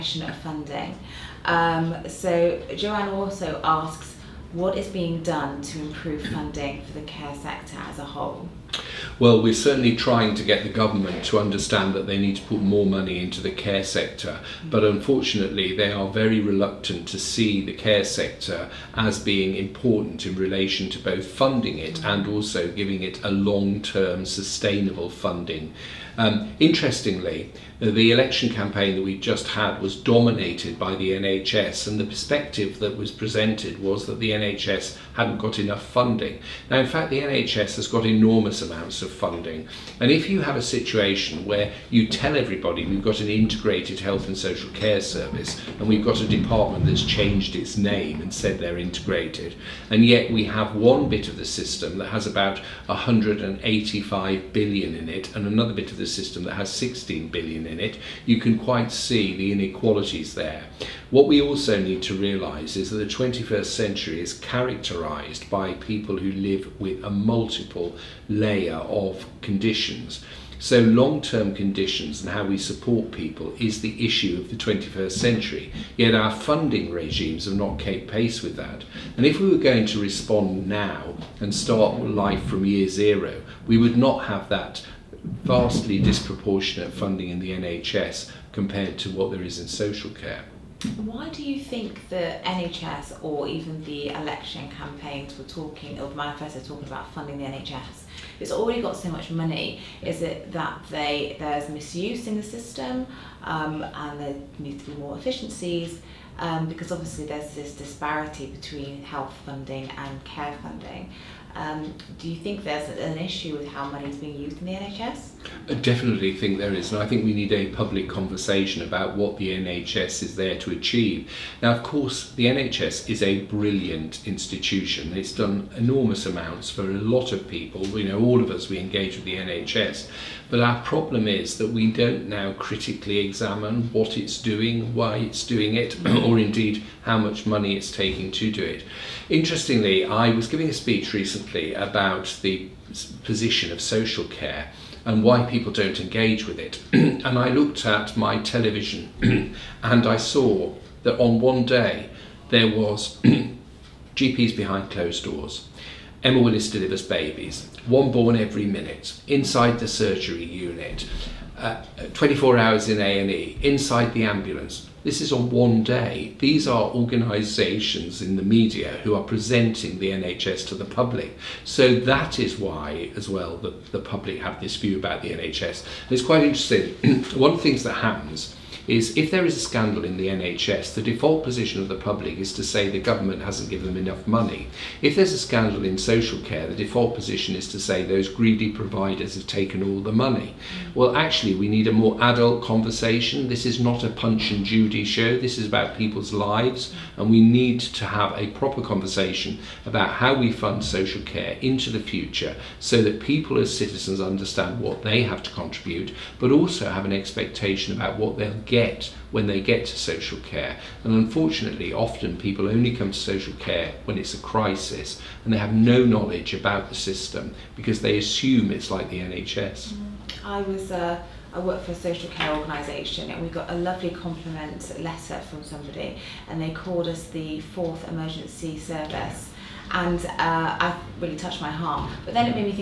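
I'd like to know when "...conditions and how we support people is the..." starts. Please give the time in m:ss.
1:11.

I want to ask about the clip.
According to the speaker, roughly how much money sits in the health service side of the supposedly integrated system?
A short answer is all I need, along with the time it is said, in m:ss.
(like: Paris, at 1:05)
185 billion, at 0:52.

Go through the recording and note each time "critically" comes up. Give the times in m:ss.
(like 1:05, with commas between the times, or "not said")
2:12.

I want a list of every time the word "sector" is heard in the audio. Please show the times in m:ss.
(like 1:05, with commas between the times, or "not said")
0:07, 0:13, 0:18.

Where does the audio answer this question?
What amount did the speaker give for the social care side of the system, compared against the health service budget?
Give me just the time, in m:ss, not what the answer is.
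0:56.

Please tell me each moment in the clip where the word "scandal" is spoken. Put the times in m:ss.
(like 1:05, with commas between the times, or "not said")
2:59, 3:05.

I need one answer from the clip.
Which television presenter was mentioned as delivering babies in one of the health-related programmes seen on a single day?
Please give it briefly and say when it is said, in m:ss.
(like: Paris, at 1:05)
Emma Willis, at 2:36.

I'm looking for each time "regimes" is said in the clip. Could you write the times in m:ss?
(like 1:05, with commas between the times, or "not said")
1:16.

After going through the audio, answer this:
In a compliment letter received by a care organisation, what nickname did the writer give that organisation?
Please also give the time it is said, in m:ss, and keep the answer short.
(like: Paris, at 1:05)
The fourth emergency service, at 3:47.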